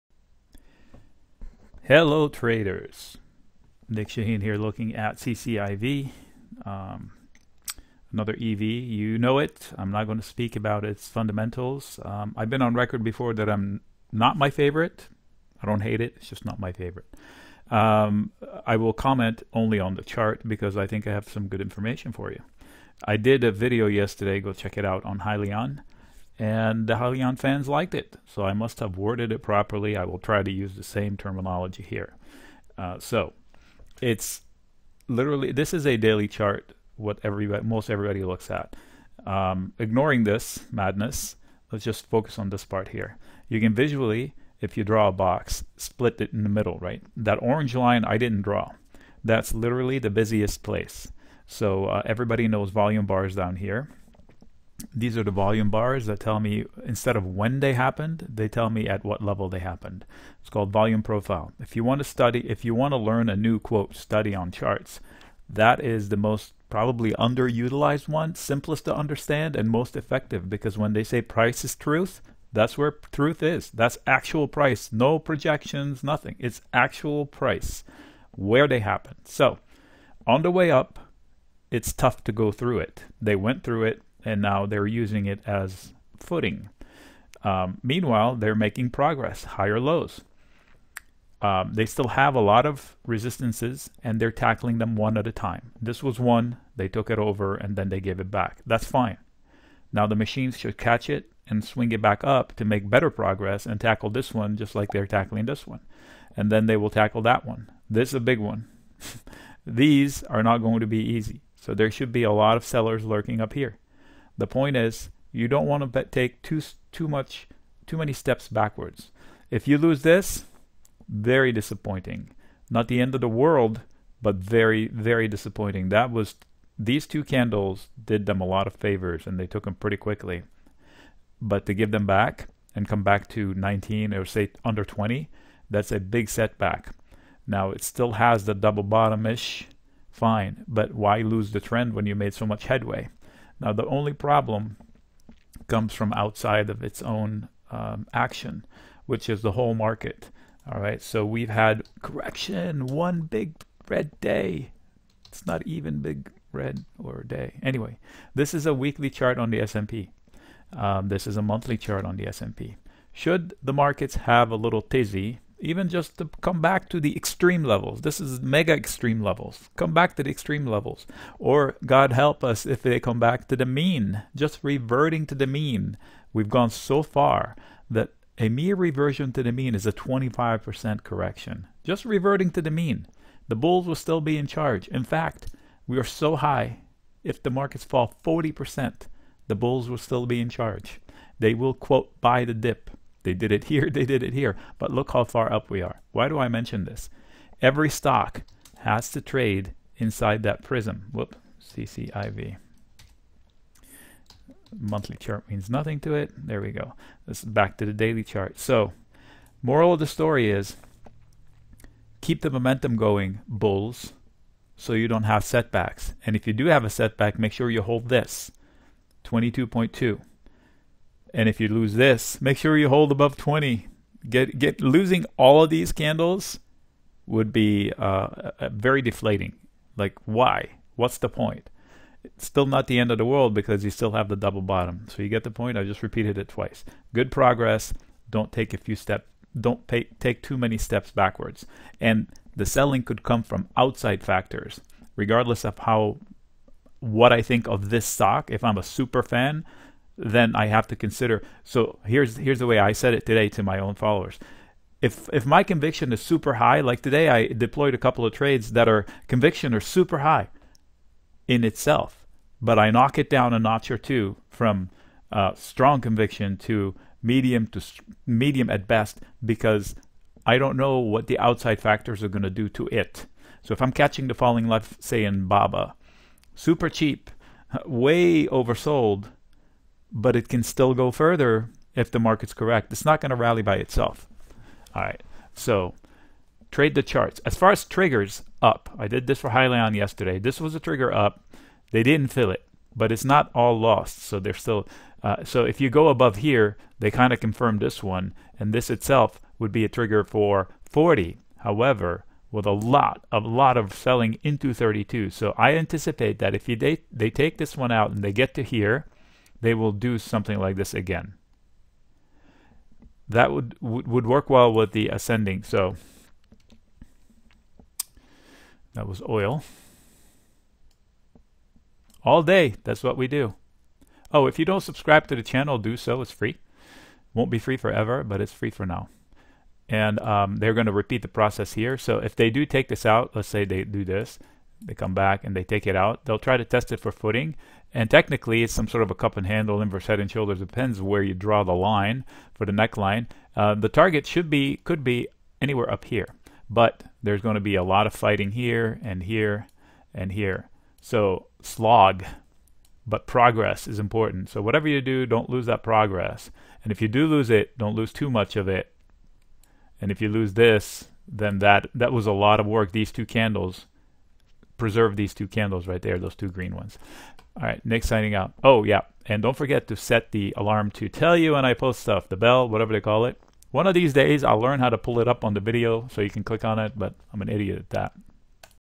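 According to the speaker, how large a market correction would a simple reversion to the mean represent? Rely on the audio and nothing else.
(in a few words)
25%.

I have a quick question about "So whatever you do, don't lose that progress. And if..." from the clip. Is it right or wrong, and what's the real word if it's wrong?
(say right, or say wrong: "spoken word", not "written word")
right.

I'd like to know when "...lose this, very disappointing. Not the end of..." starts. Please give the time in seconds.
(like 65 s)
119 s.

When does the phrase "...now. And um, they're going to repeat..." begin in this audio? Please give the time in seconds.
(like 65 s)
328 s.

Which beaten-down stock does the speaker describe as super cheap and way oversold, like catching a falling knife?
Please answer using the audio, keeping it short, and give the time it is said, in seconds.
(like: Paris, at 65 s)
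Baba, at 275 s.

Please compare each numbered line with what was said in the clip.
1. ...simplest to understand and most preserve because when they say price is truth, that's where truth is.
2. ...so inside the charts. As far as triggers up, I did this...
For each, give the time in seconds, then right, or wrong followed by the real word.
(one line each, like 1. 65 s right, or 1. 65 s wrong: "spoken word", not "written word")
1. 68 s wrong: "effective", not "preserve"
2. 285 s wrong: "trade", not "inside".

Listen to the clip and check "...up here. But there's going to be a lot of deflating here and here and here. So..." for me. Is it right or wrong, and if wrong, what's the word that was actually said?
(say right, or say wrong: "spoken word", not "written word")
wrong: "fighting", not "deflating".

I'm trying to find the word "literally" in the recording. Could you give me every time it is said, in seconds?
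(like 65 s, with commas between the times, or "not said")
35 s, 49 s.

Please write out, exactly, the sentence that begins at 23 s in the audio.
I did a video yesterday, go check it out, on Hyliion and the Hyliion fans liked it.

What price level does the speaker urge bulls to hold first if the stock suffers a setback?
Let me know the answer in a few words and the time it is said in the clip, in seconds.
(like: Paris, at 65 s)
22.2, at 219 s.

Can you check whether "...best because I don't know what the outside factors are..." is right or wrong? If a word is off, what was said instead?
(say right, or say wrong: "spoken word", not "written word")
right.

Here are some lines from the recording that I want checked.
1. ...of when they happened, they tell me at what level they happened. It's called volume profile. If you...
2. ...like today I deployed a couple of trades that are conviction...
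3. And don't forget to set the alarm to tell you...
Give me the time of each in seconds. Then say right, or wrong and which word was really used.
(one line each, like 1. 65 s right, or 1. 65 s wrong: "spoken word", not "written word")
1. 57 s right
2. 256 s right
3. 369 s right.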